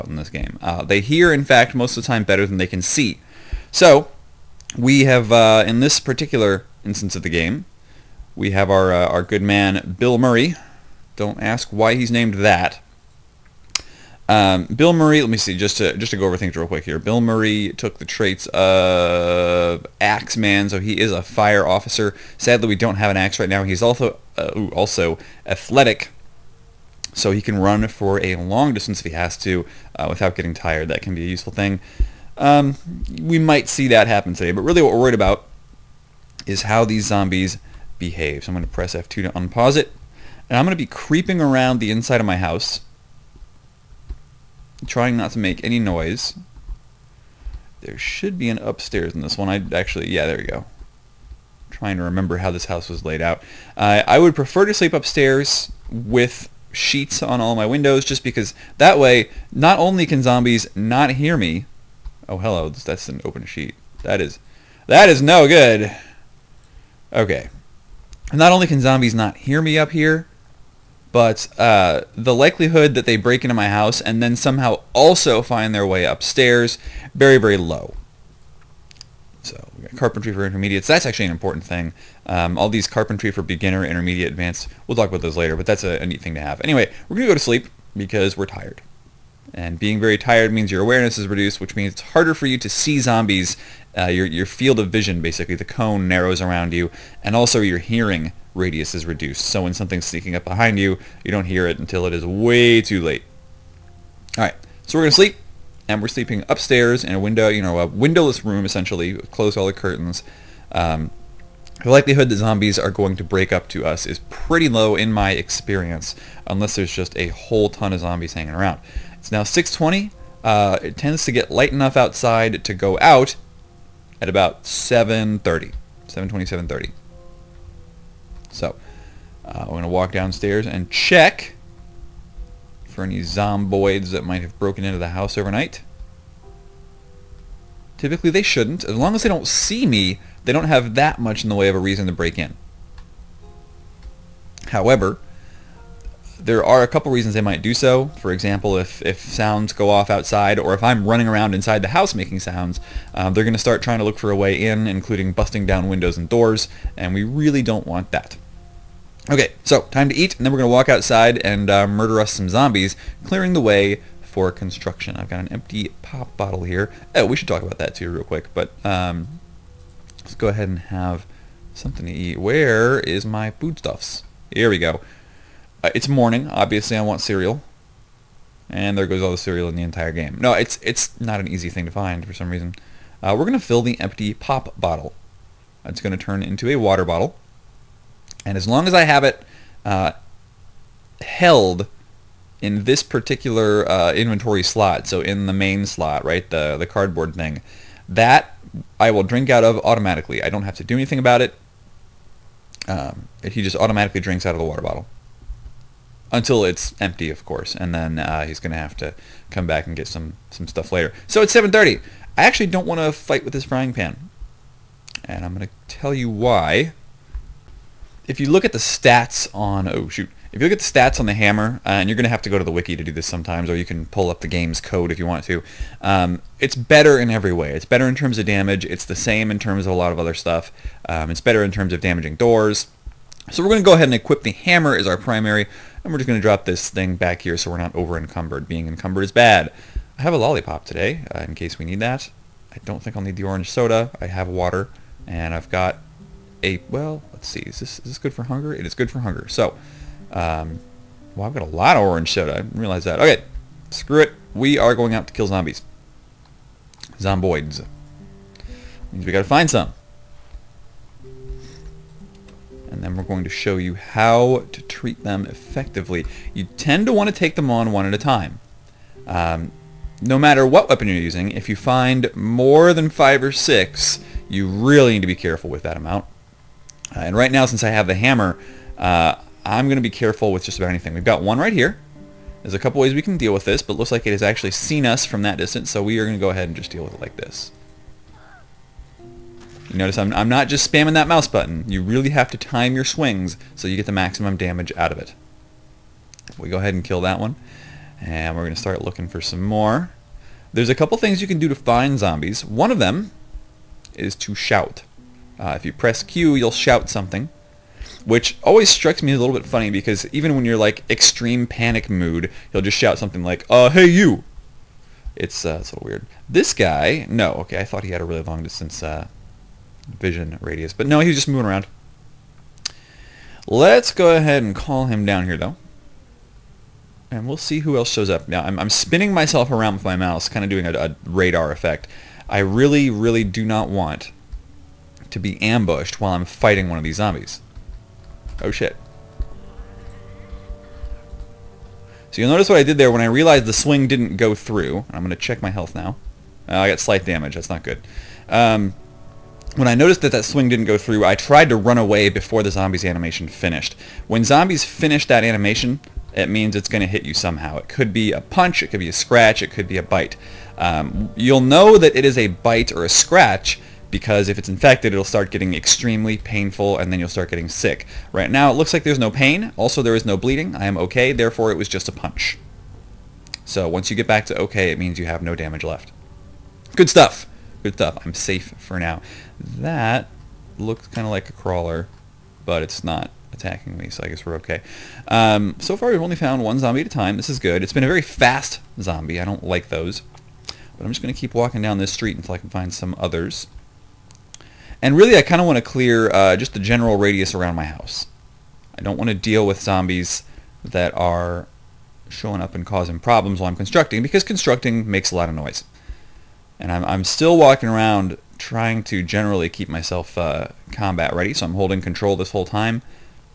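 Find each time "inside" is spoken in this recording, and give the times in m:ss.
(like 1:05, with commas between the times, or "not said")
0:41, 2:31.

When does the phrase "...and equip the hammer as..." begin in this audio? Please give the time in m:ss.
3:54.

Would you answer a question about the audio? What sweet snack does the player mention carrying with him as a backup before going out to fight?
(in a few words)
lollipop.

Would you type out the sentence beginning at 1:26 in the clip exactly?
Anyway, we're going to go to sleep because we're tired.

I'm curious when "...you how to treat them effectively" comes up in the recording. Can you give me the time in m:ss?
4:23.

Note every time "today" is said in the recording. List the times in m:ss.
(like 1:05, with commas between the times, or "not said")
0:34, 4:00.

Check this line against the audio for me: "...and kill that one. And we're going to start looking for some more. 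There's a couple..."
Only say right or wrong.
right.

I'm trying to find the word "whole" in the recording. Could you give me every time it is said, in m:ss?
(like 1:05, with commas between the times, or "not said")
1:57, 6:52.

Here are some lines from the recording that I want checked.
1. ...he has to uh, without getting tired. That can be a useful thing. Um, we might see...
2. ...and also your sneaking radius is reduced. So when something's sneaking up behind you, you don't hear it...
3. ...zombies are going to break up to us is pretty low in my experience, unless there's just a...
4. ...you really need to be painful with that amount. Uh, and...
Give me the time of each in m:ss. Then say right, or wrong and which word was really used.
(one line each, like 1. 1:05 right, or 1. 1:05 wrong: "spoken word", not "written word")
1. 0:29 right
2. 1:37 wrong: "hearing", not "sneaking"
3. 1:52 right
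4. 4:34 wrong: "careful", not "painful".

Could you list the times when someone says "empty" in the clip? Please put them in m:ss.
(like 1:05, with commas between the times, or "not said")
2:45, 3:04, 3:27.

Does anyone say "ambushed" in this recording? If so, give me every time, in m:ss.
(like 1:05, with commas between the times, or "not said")
5:35.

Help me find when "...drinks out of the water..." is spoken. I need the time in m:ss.
3:24.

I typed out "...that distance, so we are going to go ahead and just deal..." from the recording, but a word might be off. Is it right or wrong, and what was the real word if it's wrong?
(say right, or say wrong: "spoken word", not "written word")
right.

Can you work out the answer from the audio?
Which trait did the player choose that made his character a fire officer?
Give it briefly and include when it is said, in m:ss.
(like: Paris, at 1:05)
Axeman, at 0:20.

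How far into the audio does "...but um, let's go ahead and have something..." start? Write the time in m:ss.
2:48.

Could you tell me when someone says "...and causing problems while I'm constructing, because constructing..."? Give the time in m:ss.
6:42.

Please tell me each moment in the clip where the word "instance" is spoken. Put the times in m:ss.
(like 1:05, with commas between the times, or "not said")
0:06.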